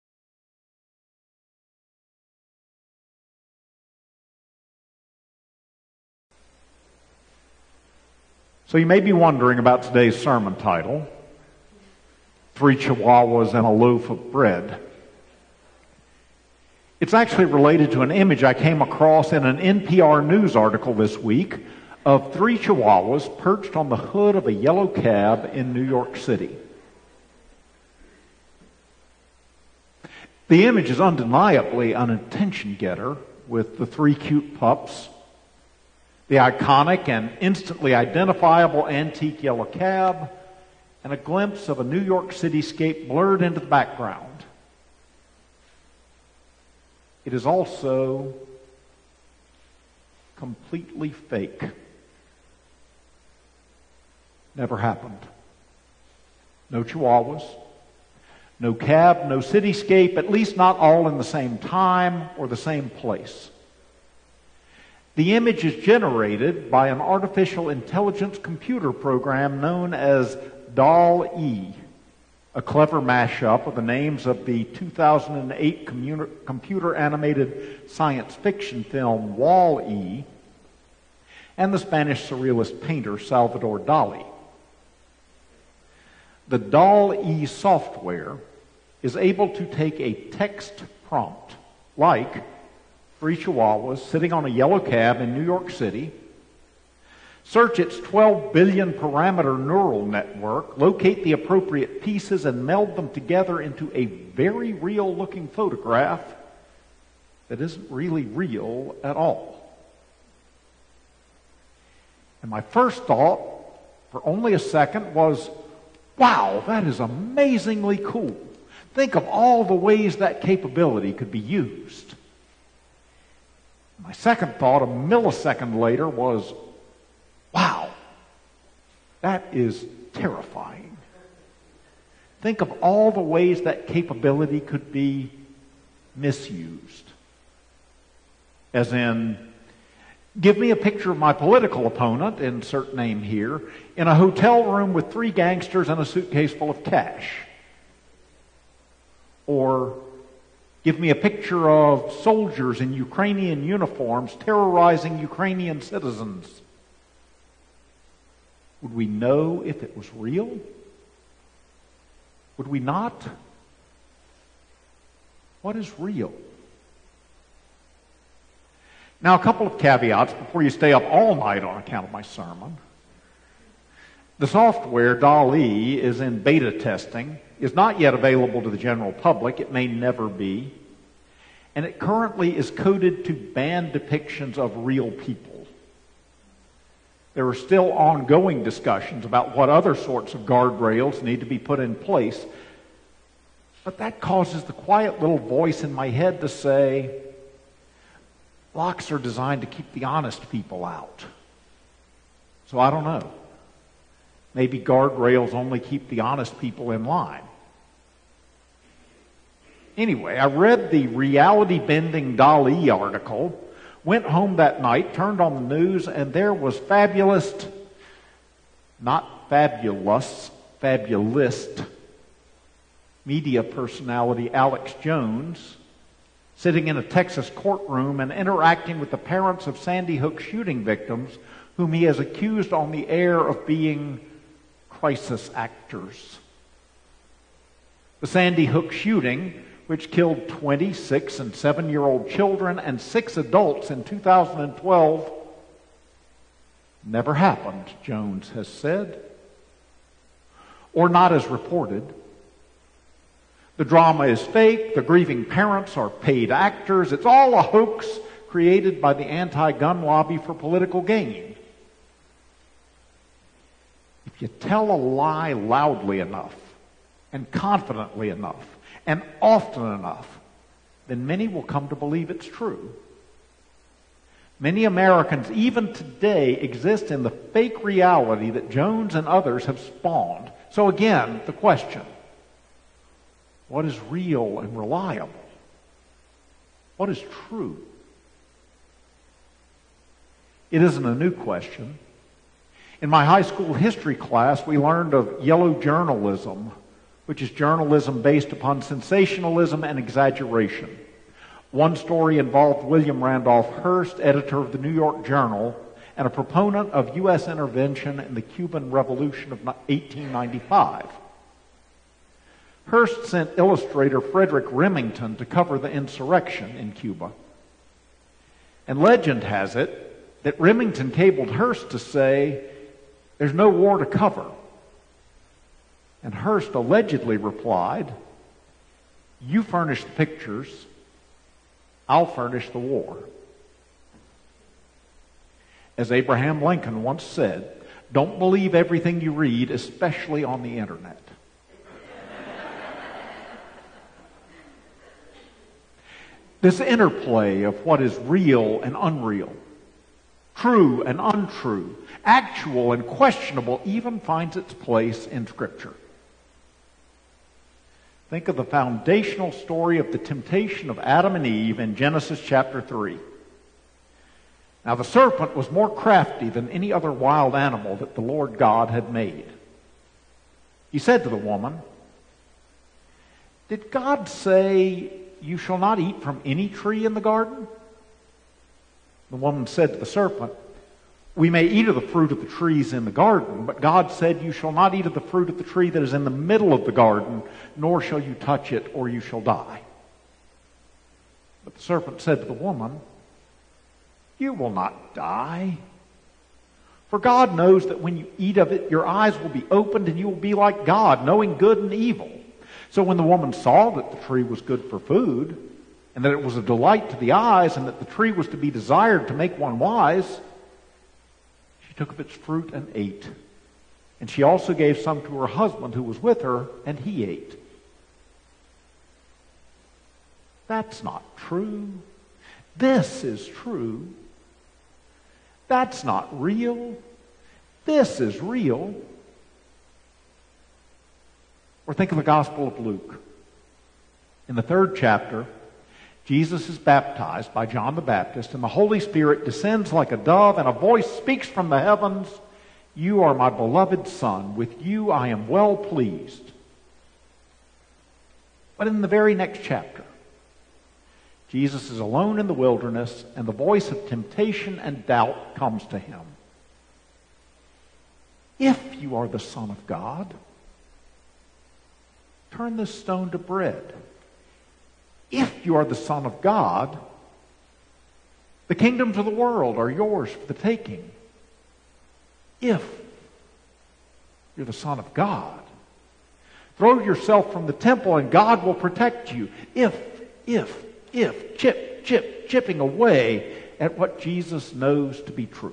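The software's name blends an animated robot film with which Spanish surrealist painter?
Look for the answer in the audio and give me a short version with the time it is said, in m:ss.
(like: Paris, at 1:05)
Salvador Dali, at 1:23.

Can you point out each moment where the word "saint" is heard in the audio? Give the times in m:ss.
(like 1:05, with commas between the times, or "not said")
not said.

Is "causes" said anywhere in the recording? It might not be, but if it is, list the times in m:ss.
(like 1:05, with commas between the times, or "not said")
3:14.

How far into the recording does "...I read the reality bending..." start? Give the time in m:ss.
3:30.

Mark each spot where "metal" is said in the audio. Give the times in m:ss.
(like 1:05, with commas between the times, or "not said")
not said.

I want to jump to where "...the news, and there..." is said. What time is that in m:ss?
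3:35.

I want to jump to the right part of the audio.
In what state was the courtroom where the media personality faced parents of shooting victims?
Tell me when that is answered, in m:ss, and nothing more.
3:47.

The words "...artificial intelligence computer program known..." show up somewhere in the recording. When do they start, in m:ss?
1:07.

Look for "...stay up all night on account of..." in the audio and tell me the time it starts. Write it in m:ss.
2:50.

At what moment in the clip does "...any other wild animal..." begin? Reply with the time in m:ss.
6:06.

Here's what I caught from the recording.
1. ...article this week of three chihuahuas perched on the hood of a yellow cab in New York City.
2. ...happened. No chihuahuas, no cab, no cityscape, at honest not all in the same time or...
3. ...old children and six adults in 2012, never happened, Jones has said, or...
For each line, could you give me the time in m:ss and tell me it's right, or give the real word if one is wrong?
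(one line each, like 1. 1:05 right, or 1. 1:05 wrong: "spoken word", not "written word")
1. 0:20 right
2. 0:54 wrong: "least", not "honest"
3. 4:02 right.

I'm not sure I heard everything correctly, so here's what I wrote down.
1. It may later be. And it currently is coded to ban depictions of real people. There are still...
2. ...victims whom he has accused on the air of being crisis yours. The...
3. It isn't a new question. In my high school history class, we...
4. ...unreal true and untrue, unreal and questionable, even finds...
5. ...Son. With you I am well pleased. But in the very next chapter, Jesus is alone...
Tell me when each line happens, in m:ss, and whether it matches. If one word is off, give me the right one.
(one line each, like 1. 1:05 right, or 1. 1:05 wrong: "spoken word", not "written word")
1. 2:59 wrong: "never", not "later"
2. 3:50 wrong: "actors", not "yours"
3. 4:50 right
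4. 5:48 wrong: "actual", not "unreal"
5. 7:24 right.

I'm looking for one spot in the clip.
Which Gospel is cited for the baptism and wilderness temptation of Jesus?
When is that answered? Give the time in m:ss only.
7:12.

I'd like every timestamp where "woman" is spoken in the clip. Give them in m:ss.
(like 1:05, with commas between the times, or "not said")
6:11, 6:19, 6:32, 6:43.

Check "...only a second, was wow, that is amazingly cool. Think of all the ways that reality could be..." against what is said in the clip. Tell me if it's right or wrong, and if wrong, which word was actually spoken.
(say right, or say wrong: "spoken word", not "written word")
wrong: "capability", not "reality".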